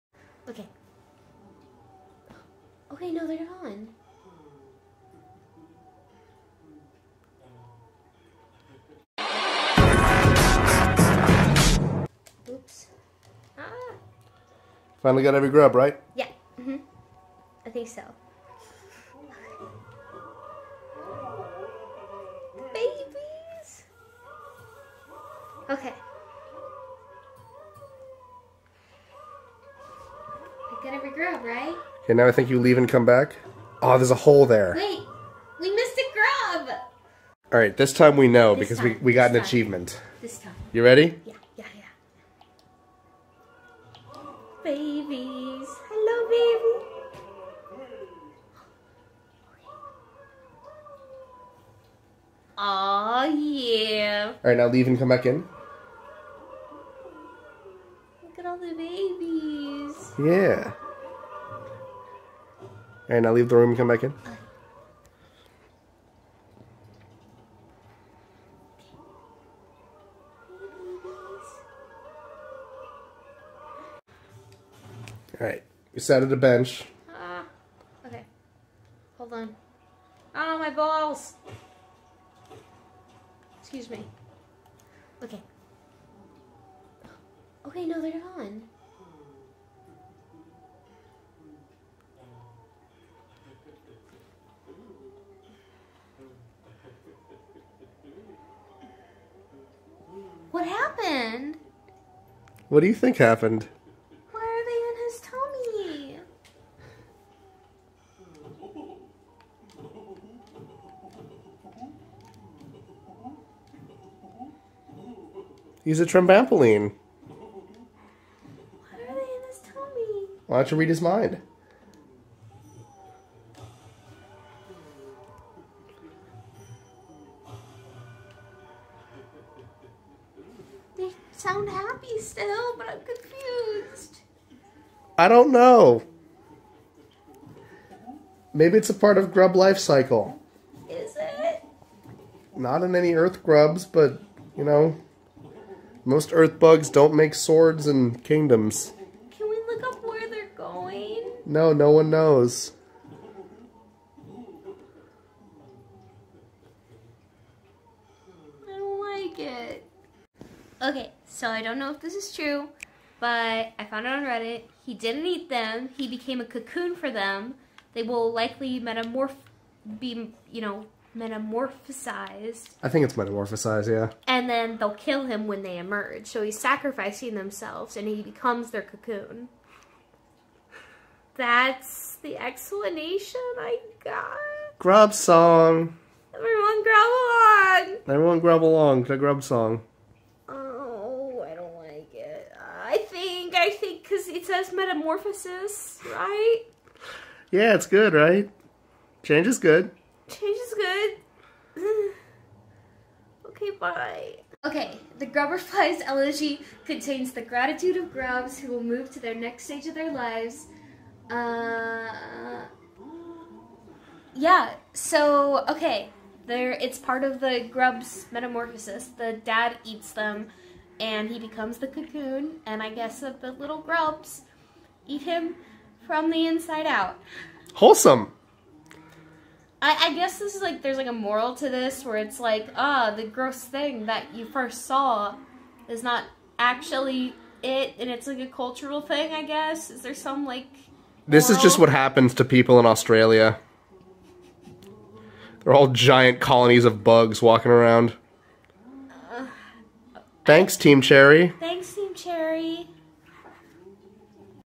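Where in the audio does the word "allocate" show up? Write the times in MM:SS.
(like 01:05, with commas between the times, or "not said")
not said.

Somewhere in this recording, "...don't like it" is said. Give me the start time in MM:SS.
02:38.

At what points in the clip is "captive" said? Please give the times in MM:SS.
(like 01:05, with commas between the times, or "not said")
not said.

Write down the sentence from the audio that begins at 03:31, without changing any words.
Uh, yeah, so, okay, there it's part of the grub's metamorphosis.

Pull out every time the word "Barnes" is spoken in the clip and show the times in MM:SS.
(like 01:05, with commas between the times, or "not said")
not said.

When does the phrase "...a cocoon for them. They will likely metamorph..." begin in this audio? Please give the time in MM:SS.
02:46.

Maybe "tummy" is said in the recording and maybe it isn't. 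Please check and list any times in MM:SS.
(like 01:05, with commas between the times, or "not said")
01:45, 01:59.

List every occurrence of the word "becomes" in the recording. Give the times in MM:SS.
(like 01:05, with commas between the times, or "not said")
02:58, 03:41.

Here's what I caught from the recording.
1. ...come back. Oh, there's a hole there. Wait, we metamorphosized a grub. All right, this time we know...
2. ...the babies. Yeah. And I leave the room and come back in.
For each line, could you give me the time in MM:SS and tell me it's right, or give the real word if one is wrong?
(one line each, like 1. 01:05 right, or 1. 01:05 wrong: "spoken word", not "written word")
1. 00:32 wrong: "missed", not "metamorphosized"
2. 00:58 right.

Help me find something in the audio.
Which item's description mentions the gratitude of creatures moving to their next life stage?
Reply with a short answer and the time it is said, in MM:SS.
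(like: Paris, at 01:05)
Grubberfly's elegy, at 03:25.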